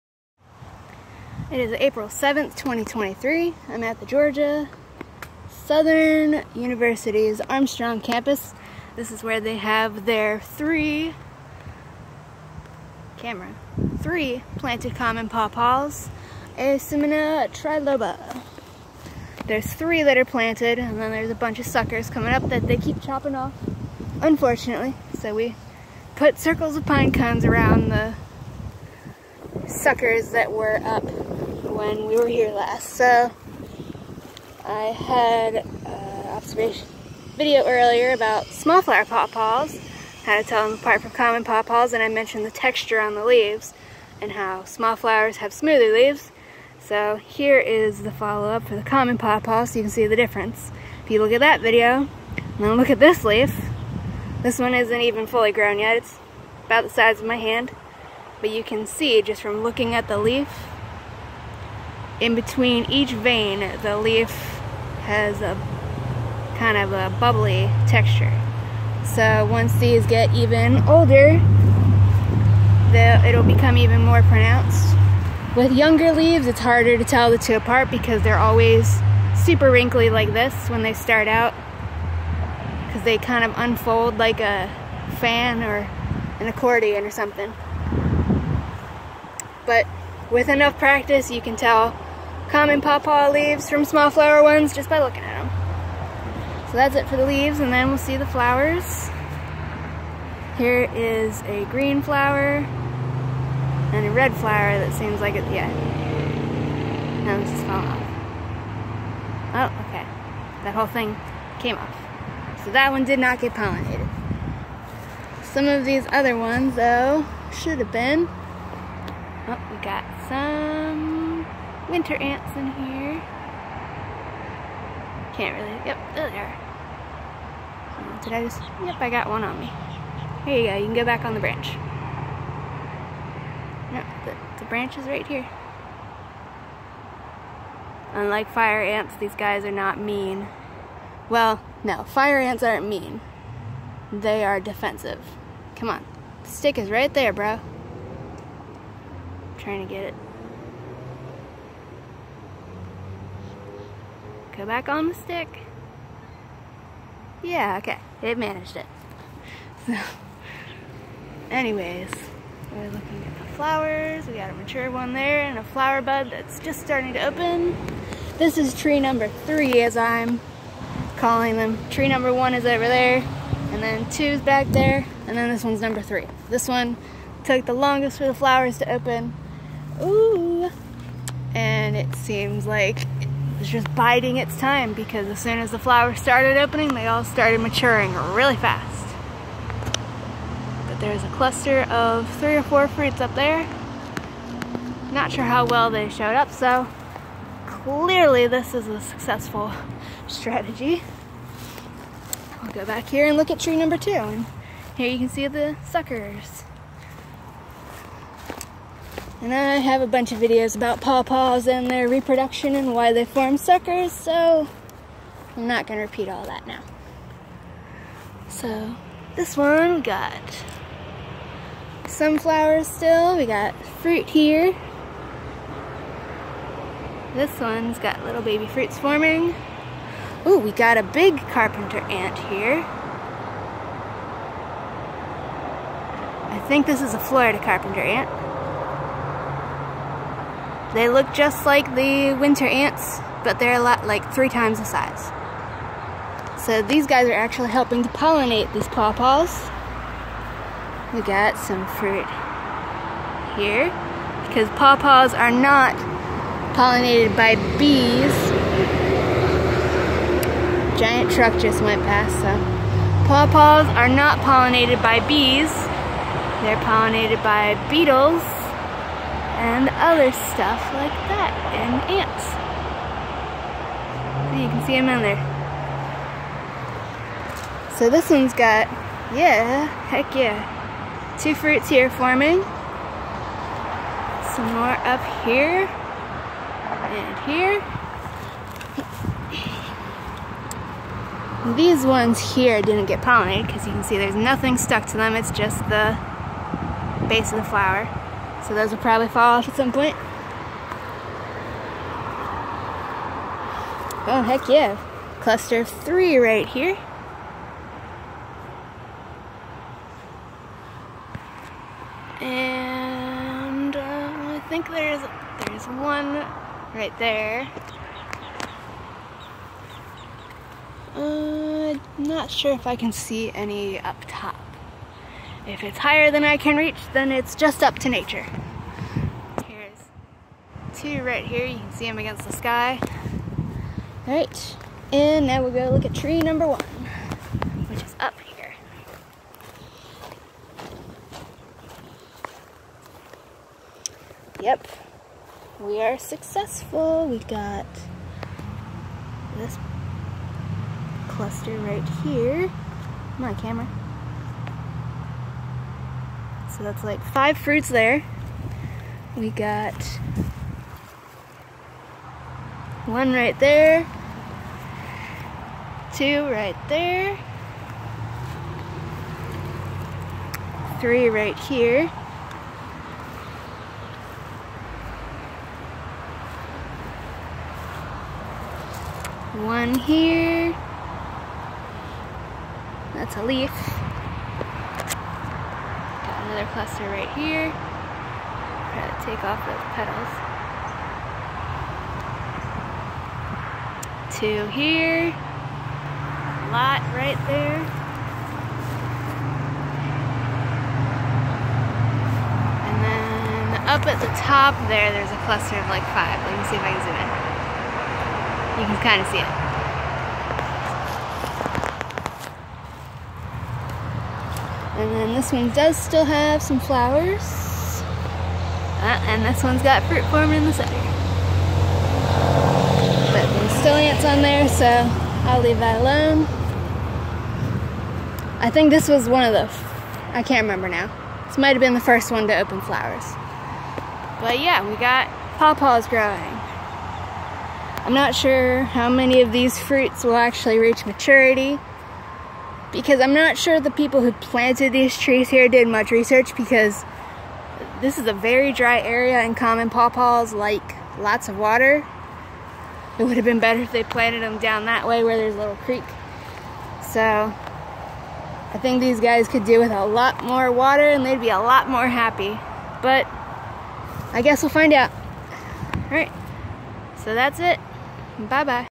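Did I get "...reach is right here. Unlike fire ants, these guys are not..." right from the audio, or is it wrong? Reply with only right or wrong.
wrong.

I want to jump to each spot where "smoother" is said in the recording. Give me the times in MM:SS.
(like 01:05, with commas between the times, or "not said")
00:45.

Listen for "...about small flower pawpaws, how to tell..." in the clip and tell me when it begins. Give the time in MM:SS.
00:38.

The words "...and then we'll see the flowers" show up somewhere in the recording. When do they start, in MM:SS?
01:37.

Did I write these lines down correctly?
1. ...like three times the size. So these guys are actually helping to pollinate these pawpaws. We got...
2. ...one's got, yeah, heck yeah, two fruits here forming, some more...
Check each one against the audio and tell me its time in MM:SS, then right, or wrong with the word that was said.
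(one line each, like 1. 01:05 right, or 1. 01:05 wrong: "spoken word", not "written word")
1. 04:04 right
2. 04:38 right.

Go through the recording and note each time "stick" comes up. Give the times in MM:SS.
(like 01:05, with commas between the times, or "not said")
02:26, 02:35.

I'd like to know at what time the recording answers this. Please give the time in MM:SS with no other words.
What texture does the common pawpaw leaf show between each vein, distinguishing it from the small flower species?
01:07.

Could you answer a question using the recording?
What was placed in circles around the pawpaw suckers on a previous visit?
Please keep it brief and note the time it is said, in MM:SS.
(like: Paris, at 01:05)
Pine cones, at 00:26.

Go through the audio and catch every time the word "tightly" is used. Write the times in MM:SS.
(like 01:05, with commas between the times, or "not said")
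not said.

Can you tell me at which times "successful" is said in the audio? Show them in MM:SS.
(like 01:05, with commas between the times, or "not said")
03:18, 05:46.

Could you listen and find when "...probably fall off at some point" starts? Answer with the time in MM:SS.
04:58.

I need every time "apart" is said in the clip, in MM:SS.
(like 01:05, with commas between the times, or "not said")
00:40, 01:17.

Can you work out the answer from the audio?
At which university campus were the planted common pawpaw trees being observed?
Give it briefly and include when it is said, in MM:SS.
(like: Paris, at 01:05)
Armstrong campus, at 00:07.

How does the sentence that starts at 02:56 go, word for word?
This one took the longest for the flowers to open.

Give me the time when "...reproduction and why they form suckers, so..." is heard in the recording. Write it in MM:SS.
03:32.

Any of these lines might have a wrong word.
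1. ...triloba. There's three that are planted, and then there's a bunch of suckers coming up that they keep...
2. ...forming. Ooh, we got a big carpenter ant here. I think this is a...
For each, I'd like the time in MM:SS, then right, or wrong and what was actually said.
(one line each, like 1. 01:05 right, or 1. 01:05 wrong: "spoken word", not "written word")
1. 00:17 right
2. 03:48 right.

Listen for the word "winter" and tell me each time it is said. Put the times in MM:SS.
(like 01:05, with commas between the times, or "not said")
02:01, 04:02.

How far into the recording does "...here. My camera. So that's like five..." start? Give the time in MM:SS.
05:52.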